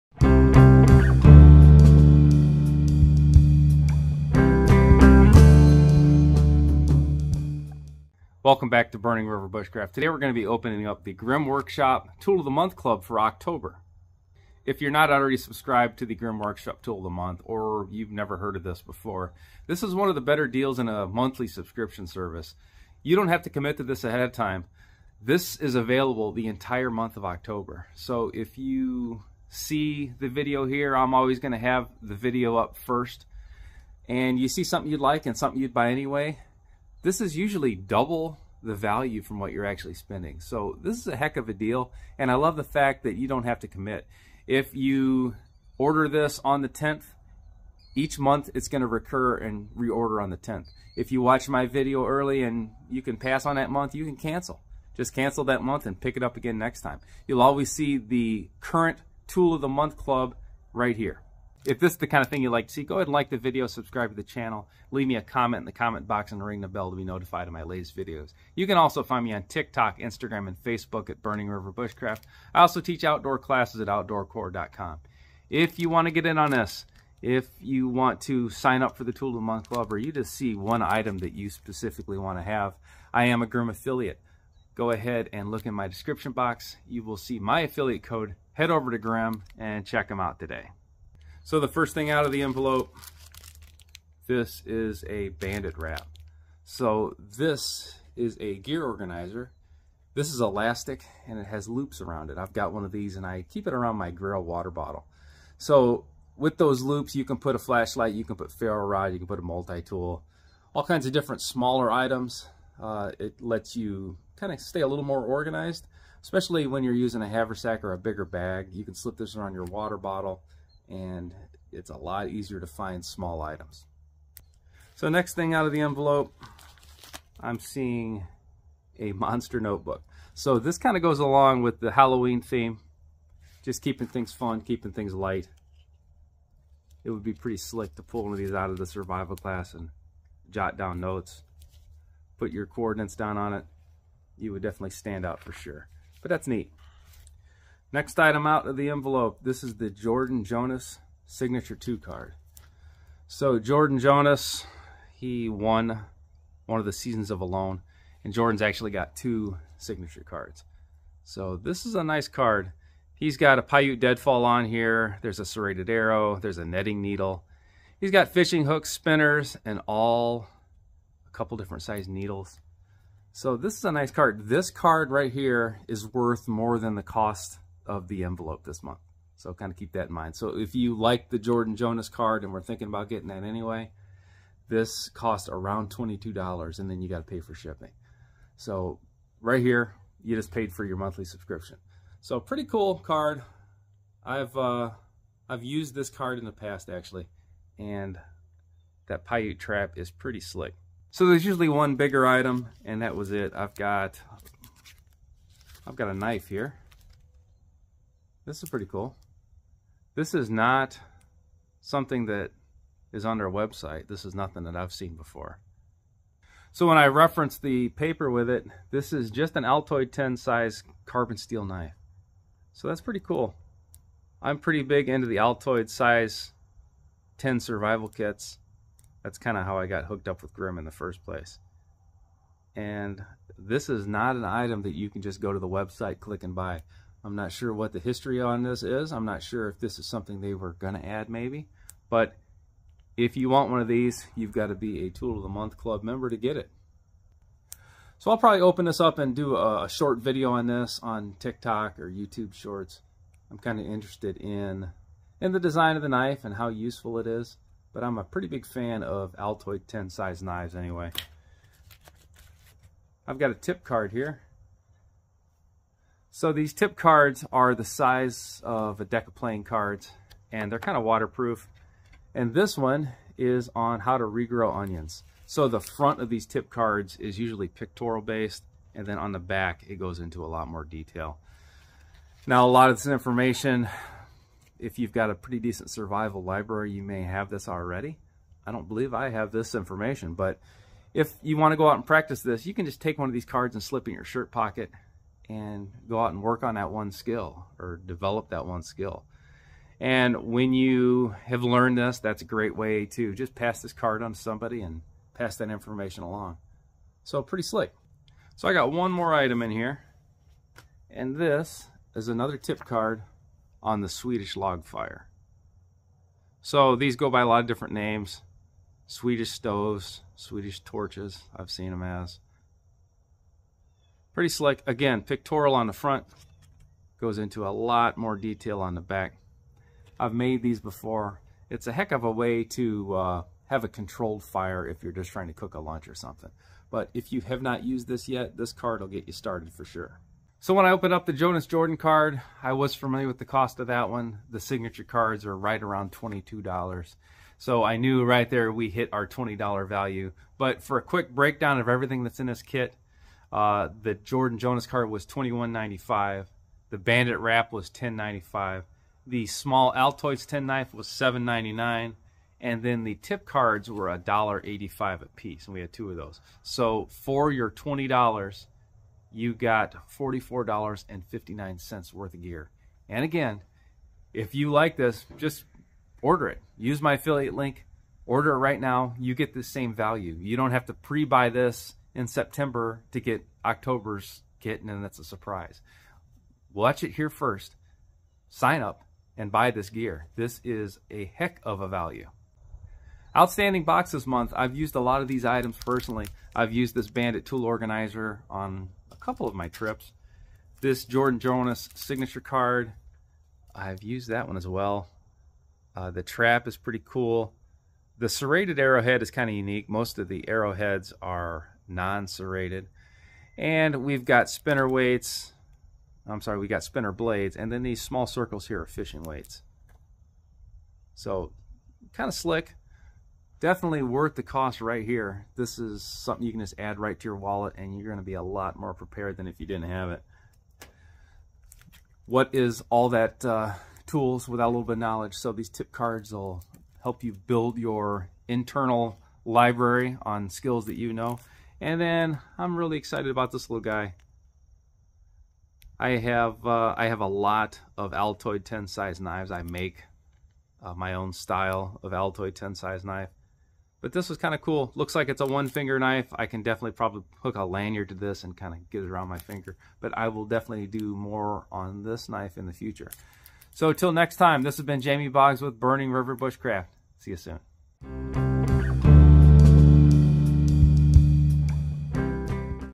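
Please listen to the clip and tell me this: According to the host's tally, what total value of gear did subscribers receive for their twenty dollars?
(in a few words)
$44.59.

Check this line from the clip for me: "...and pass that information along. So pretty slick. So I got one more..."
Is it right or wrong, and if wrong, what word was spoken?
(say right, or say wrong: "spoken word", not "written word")
right.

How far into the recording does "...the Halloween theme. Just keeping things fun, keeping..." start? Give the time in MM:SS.
02:11.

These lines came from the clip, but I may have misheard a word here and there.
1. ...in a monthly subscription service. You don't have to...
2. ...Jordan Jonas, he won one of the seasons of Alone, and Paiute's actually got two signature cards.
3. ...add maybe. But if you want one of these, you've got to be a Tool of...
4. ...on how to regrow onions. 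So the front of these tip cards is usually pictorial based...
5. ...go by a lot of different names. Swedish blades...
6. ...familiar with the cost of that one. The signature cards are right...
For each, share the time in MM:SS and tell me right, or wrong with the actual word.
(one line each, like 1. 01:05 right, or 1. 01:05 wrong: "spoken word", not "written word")
1. 00:20 right
2. 02:33 wrong: "Jordan", not "Paiute"
3. 04:01 right
4. 04:33 right
5. 05:17 wrong: "stoves", not "blades"
6. 05:42 right.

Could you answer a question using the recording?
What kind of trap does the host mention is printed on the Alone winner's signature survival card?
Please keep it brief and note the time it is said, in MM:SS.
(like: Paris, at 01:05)
Paiute Deadfall, at 02:43.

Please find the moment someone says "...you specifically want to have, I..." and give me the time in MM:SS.
01:21.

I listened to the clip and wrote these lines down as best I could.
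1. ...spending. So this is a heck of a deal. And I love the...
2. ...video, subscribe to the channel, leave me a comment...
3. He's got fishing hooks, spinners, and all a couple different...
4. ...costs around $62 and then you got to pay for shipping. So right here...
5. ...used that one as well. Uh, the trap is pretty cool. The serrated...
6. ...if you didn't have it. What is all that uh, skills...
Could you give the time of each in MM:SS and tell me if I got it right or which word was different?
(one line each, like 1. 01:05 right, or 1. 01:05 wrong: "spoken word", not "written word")
1. 00:39 right
2. 01:03 right
3. 02:47 right
4. 03:05 wrong: "22", not "62"
5. 06:44 right
6. 07:09 wrong: "tools", not "skills".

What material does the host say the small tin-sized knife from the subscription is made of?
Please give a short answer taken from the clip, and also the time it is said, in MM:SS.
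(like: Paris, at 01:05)
Carbon steel, at 03:41.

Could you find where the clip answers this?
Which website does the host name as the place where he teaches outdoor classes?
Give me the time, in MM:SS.
01:13.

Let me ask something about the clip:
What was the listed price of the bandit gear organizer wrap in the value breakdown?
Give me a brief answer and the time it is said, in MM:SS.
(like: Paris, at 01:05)
$10.95, at 05:57.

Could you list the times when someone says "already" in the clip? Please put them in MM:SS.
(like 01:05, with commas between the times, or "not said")
00:15, 04:47.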